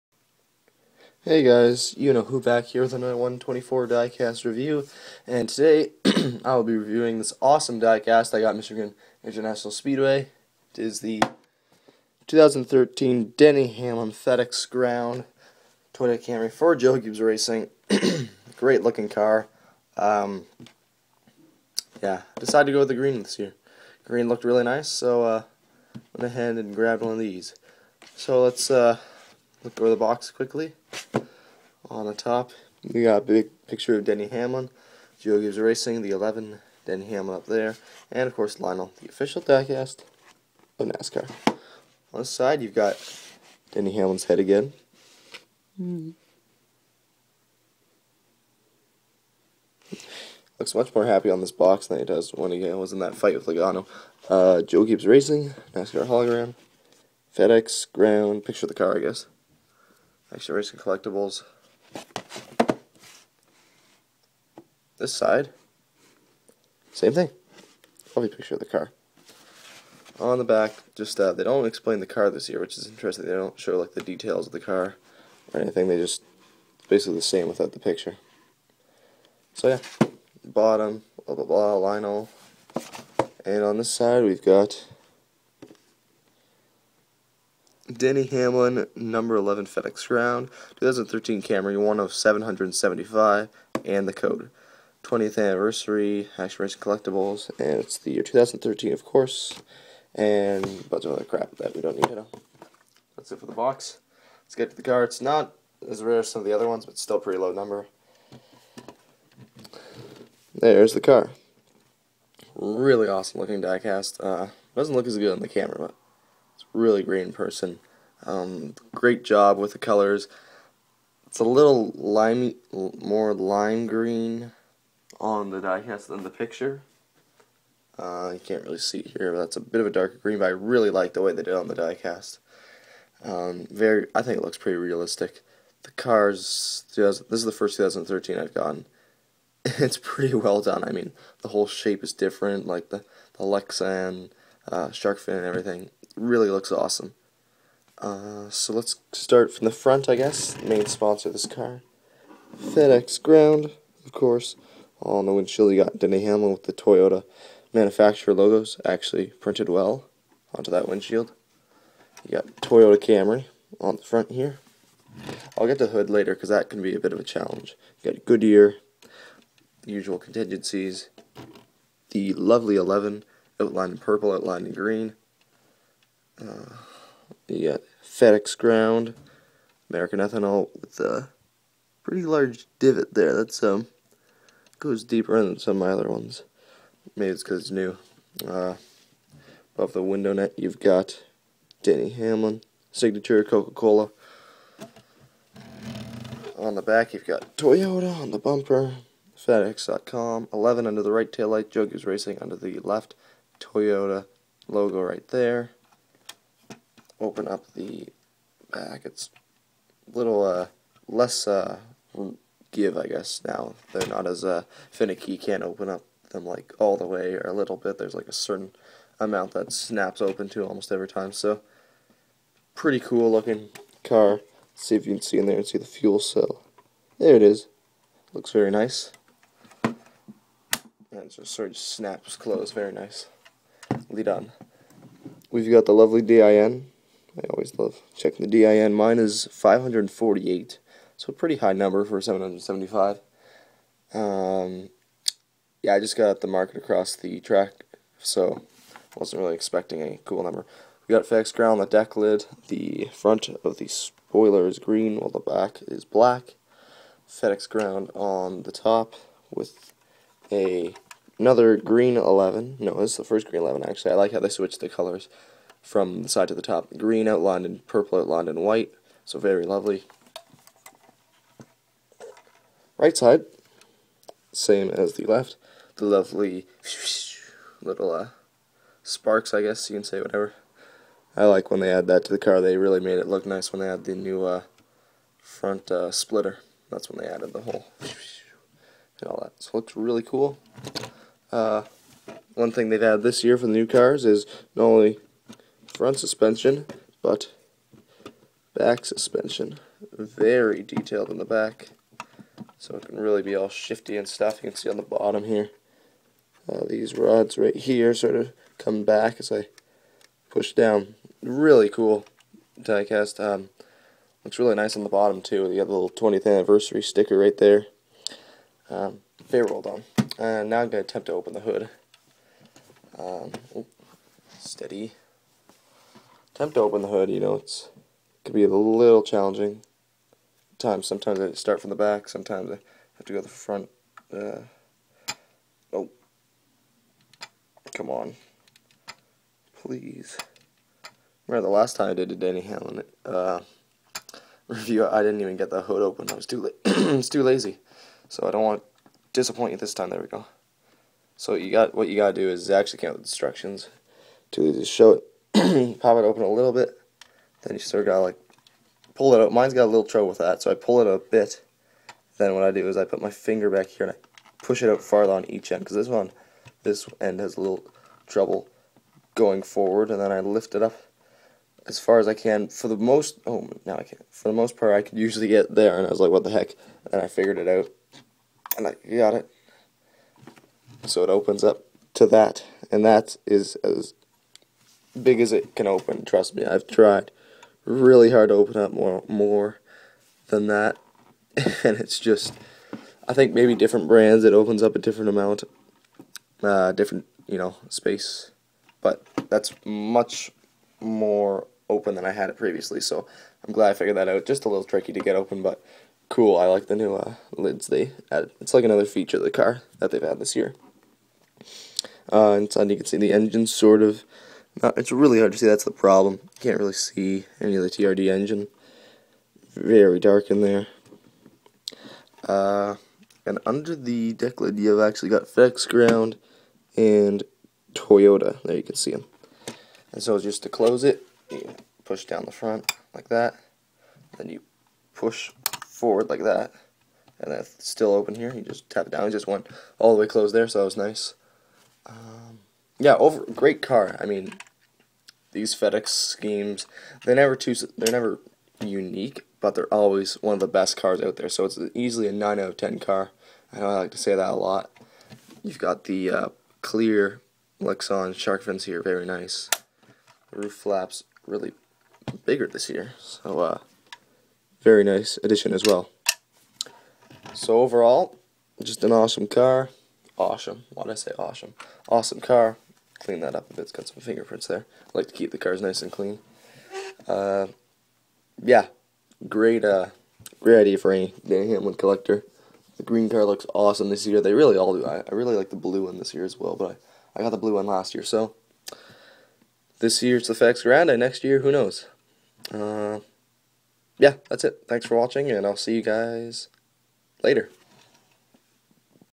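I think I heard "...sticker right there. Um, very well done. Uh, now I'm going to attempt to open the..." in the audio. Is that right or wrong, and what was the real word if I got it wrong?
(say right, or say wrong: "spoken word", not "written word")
right.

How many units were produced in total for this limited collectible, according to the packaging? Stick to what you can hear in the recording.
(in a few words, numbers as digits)
775.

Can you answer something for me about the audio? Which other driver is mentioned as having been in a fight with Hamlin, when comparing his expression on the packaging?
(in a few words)
Logano.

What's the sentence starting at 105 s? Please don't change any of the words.
It's not as rare as some of the other ones, but still pretty low number.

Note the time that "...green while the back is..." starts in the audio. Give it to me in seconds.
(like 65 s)
254 s.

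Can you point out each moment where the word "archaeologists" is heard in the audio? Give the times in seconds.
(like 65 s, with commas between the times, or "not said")
not said.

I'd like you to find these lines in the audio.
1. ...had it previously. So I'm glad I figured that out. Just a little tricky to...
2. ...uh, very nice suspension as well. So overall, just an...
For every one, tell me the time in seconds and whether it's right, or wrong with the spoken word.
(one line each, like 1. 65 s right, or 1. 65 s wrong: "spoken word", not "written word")
1. 402 s right
2. 463 s wrong: "addition", not "suspension".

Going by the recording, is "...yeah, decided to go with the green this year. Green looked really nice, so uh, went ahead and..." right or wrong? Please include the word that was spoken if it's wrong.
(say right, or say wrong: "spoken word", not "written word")
right.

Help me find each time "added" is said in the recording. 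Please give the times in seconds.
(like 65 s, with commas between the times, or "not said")
287 s, 293 s, 408 s.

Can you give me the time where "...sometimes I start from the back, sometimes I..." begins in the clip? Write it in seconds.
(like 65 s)
331 s.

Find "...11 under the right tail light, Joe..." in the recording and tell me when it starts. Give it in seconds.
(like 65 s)
200 s.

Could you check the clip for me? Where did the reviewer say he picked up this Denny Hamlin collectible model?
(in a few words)
Michigan International Speedway.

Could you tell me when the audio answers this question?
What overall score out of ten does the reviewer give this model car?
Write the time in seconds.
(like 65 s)
452 s.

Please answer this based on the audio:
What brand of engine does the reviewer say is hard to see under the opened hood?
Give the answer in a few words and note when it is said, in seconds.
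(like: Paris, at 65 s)
TRD, at 417 s.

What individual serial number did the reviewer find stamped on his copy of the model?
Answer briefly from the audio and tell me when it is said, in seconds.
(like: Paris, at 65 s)
548, at 239 s.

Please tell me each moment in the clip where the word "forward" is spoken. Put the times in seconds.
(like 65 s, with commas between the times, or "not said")
369 s, 435 s.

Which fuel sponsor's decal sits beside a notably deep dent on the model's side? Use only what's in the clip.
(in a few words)
American ethanol.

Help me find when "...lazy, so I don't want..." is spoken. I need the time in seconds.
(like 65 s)
347 s.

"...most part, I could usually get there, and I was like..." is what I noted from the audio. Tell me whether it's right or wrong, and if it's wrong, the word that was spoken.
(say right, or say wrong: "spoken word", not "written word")
right.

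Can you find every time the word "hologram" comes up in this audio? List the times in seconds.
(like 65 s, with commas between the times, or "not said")
56 s.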